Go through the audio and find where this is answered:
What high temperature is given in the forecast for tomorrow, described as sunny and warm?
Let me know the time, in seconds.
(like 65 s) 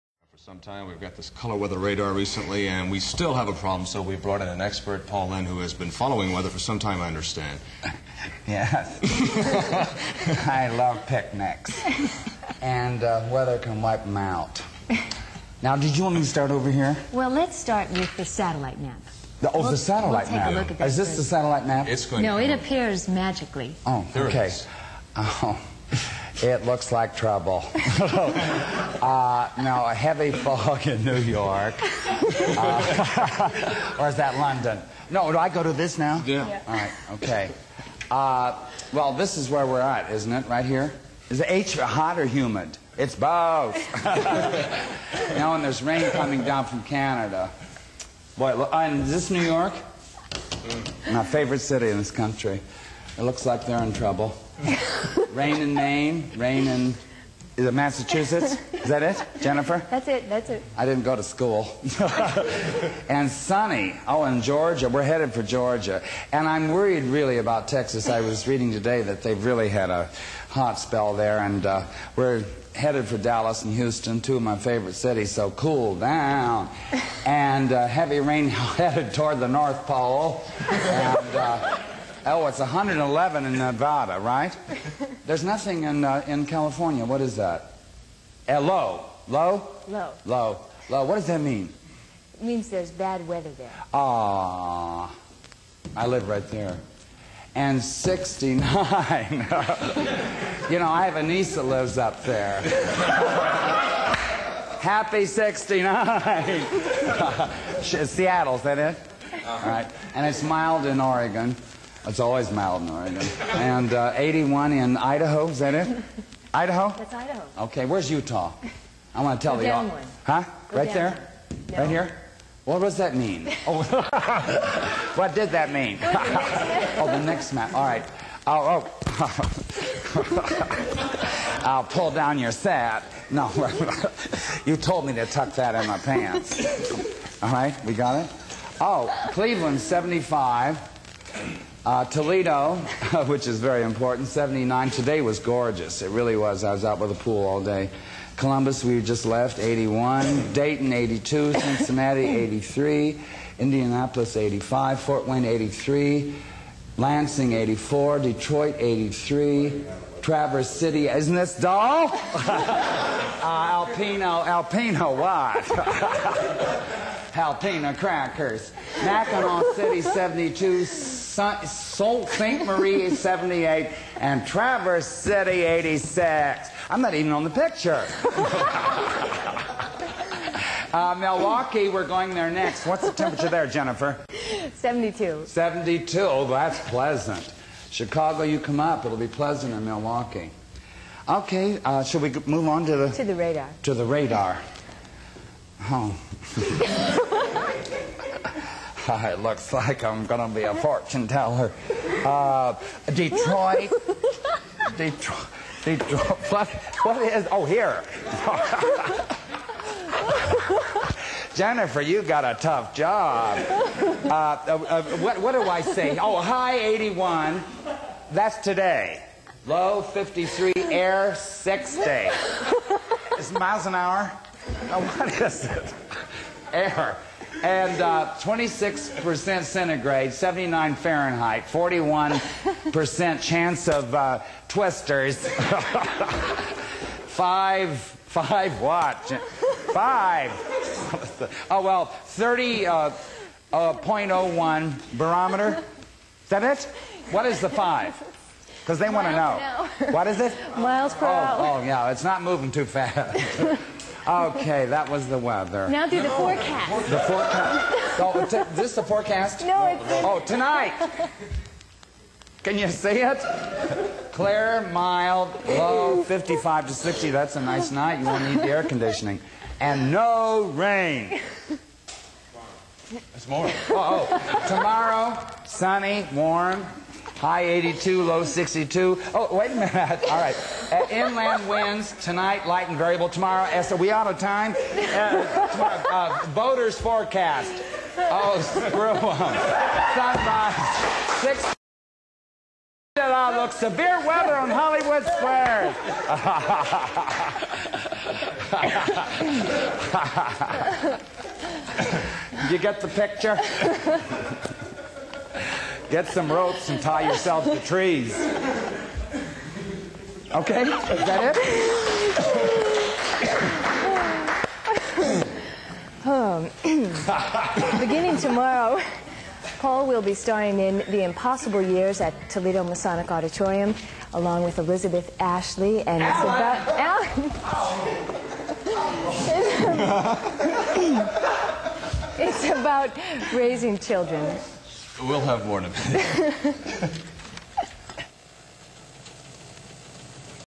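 277 s.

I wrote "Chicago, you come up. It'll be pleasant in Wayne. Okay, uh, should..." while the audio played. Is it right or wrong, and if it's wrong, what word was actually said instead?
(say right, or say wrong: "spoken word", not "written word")
wrong: "Milwaukee", not "Wayne".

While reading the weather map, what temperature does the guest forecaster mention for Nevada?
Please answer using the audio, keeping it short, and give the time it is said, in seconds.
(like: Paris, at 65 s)
111, at 82 s.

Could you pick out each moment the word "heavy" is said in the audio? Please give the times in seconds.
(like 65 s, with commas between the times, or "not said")
29 s, 77 s.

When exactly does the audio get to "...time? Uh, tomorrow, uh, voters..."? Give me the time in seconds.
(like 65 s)
284 s.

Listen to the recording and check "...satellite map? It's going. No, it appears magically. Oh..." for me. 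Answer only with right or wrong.
right.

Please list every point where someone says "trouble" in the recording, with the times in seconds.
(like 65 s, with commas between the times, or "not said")
27 s, 53 s.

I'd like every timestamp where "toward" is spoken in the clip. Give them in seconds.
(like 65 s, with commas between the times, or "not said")
79 s.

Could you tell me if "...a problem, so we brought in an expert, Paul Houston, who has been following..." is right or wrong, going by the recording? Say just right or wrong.
wrong.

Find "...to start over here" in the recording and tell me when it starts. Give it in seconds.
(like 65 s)
16 s.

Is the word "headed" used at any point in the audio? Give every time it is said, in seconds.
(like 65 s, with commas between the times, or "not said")
65 s, 72 s, 78 s.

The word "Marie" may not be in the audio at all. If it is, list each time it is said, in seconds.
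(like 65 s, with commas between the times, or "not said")
172 s.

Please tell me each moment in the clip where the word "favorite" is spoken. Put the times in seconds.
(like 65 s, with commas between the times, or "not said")
51 s, 74 s.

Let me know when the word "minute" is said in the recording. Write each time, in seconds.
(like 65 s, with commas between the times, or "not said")
279 s, 335 s.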